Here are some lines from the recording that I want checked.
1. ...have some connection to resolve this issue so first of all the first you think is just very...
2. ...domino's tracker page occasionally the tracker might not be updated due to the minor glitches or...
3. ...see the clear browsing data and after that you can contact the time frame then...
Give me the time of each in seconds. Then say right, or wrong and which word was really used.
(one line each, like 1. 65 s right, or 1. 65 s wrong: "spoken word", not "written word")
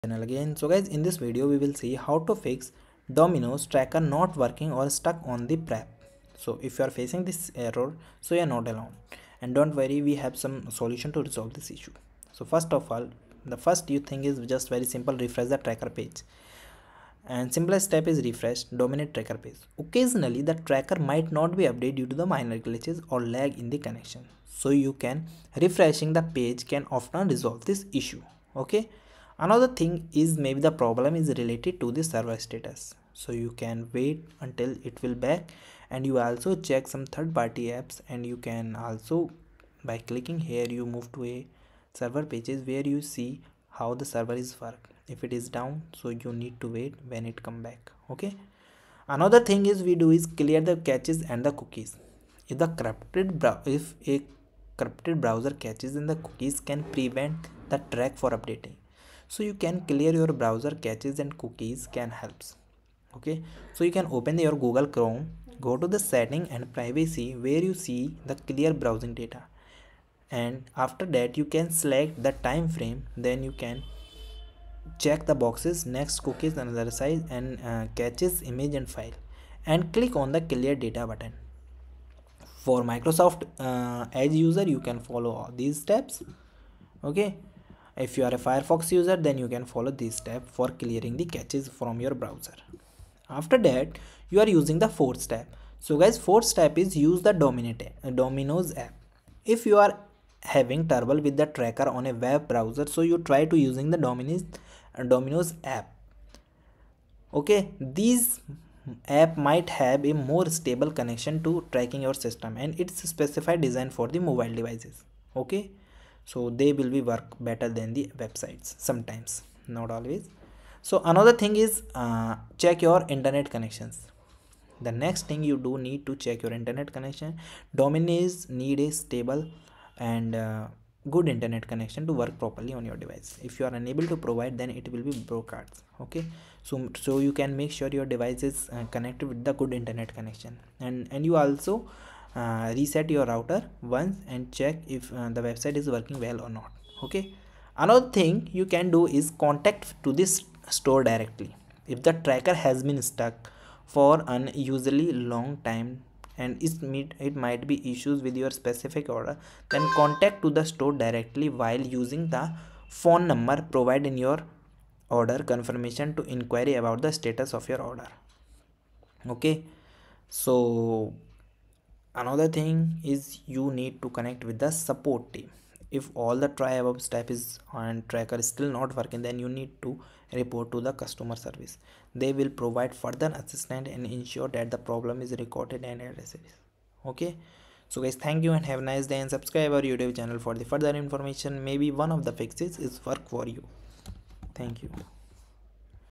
1. 10 s wrong: "solution", not "connection"
2. 18 s right
3. 67 s wrong: "select", not "contact".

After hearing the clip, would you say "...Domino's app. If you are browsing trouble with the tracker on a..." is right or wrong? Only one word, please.
wrong.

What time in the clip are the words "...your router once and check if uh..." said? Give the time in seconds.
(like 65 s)
143 s.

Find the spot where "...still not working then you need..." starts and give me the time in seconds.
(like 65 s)
178 s.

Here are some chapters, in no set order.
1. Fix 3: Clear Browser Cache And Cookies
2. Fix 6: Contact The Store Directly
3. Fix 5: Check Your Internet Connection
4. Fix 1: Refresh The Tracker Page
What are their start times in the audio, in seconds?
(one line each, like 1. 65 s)
1. 51 s
2. 149 s
3. 124 s
4. 15 s.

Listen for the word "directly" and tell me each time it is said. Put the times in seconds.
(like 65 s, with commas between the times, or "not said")
151 s, 160 s.